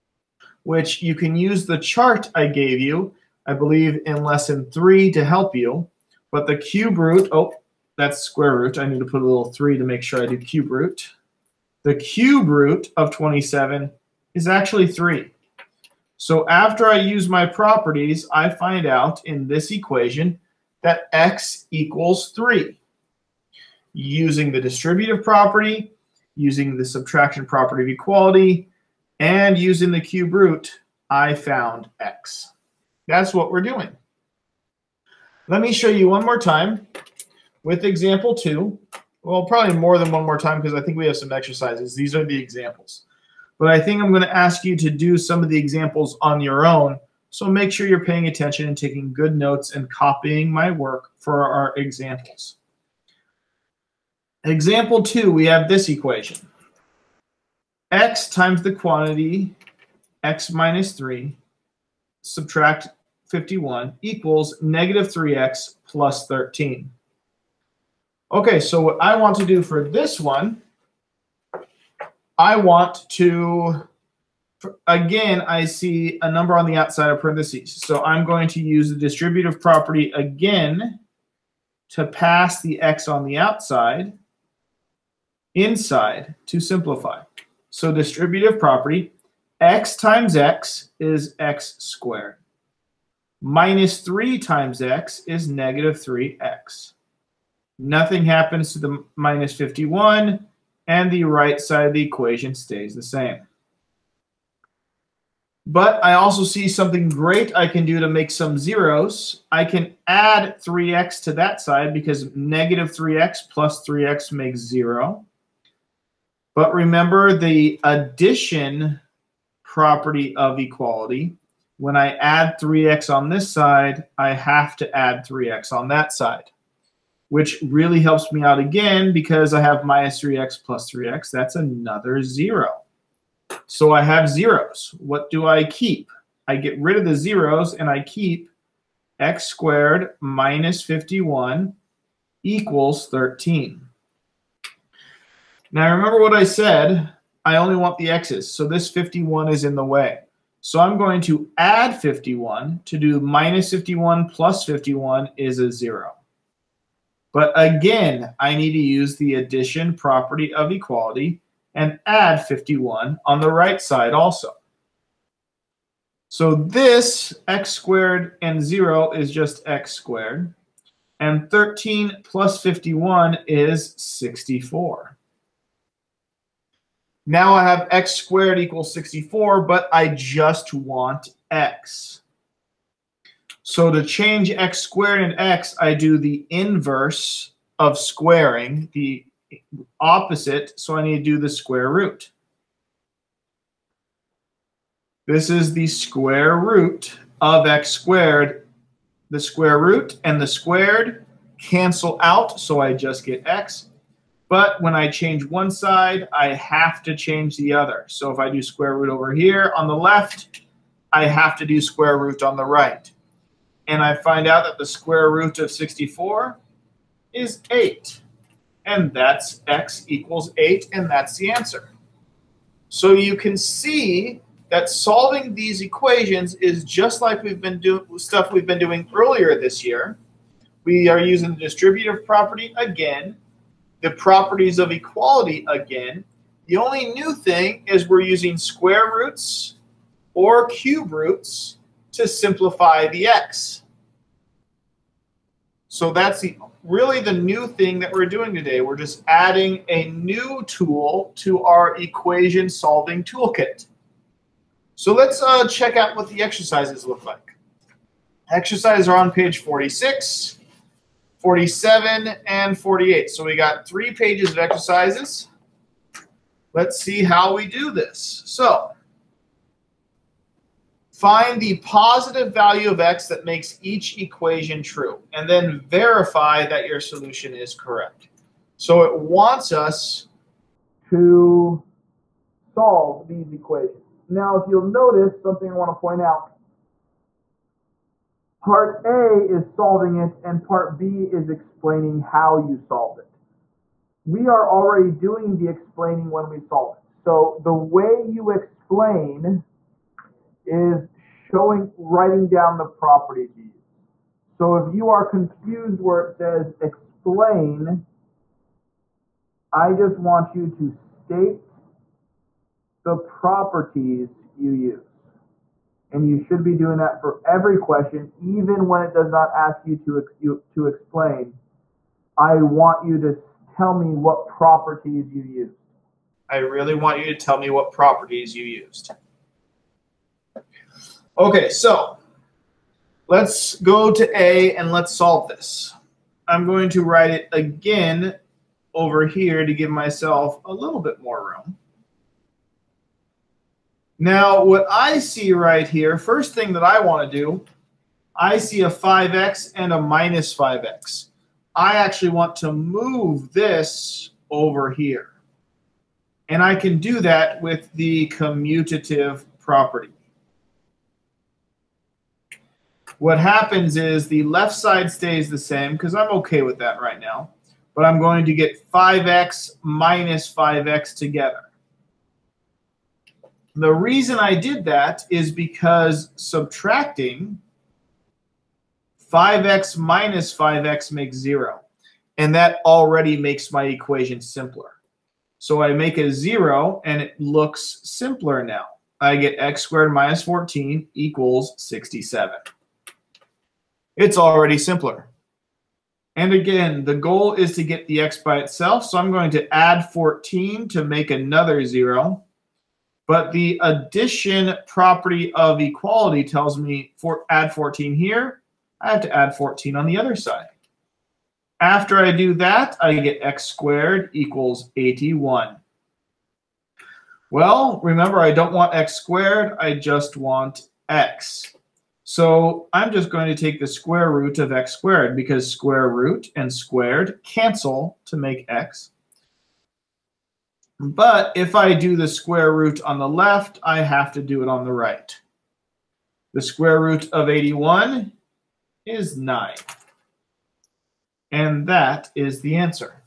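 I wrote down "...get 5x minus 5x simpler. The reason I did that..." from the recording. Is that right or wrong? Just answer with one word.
wrong.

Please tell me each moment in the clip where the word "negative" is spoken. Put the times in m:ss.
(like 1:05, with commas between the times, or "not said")
1:04, 1:35, 1:52.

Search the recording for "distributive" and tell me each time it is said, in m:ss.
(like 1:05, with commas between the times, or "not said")
0:24, 1:18, 1:27, 3:51.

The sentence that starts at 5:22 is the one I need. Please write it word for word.
I want you to tell me what properties you used.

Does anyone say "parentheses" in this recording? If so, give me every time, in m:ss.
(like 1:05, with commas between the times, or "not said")
1:17.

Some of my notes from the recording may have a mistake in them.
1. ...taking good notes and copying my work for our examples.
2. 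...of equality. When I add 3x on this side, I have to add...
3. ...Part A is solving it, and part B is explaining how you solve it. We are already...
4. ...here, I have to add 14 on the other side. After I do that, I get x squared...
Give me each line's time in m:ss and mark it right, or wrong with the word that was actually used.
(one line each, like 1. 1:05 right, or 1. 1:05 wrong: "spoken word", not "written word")
1. 0:48 right
2. 2:00 right
3. 4:48 right
4. 6:48 right.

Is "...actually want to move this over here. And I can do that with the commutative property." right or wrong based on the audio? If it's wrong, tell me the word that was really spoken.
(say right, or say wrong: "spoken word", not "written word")
right.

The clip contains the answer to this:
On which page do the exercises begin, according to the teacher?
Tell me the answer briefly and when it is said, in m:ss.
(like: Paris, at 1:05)
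46, at 4:19.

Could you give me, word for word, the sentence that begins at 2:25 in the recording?
Now remember what I said, I only want the x's, so this 51 is in the way.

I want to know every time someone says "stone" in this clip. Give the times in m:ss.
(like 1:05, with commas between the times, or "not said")
not said.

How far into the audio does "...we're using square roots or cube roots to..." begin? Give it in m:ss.
3:58.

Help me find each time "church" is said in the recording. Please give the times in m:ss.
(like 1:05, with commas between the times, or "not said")
not said.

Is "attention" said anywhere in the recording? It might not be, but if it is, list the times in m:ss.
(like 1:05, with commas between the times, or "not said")
0:48.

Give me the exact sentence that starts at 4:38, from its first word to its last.
So it wants us to solve these equations.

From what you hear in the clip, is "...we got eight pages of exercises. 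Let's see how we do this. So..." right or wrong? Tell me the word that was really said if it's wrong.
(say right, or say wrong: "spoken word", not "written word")
wrong: "three", not "eight".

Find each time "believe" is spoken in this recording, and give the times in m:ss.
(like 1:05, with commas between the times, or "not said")
0:03.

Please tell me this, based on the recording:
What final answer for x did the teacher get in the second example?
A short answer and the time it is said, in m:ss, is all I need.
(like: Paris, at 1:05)
8, at 3:39.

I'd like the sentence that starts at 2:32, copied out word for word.
To do minus 51 plus 51 is a zero.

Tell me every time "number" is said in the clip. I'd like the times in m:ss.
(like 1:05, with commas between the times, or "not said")
1:16.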